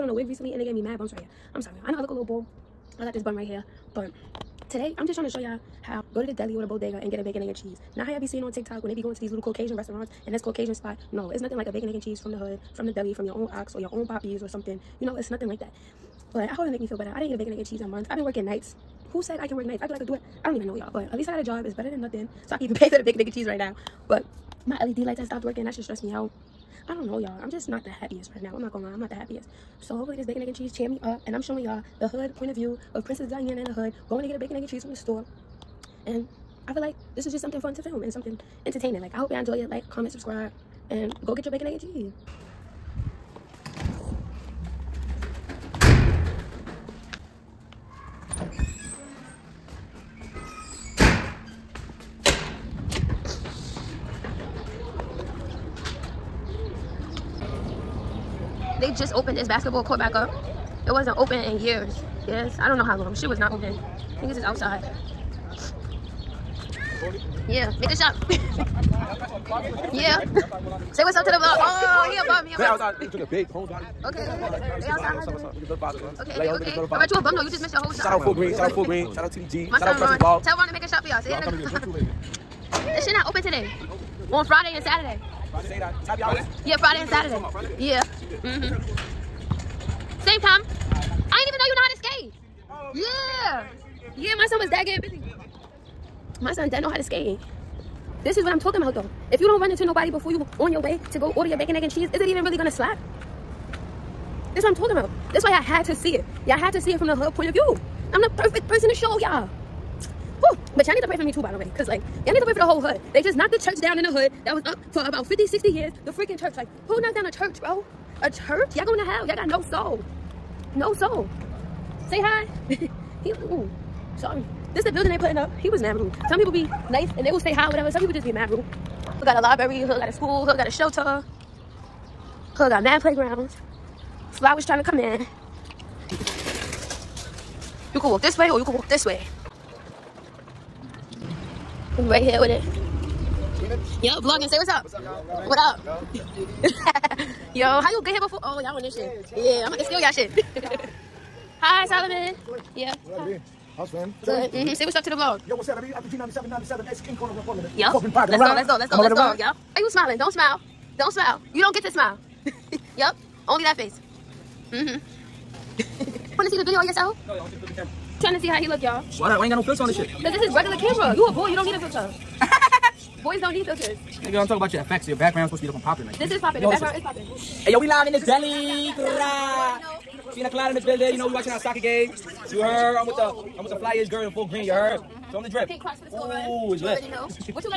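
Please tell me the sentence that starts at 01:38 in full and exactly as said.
This is what I'm talking about though.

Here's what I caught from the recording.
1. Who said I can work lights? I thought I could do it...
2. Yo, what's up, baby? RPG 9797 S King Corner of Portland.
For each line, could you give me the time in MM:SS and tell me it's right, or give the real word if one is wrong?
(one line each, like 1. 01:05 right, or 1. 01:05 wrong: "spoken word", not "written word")
1. 00:19 wrong: "nights", not "lights"
2. 02:35 right.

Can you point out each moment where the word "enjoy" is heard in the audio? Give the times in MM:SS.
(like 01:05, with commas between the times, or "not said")
00:39.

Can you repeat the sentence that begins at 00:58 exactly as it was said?
they just opened this basketball court back up.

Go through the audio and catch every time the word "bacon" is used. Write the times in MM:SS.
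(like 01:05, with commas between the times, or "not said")
00:07, 00:11, 00:17, 00:23, 00:30, 00:34, 00:41, 01:41.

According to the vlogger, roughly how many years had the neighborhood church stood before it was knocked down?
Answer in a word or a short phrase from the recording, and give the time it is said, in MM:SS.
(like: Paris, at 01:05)
50, 60 years, at 01:55.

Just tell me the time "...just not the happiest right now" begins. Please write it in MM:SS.
00:27.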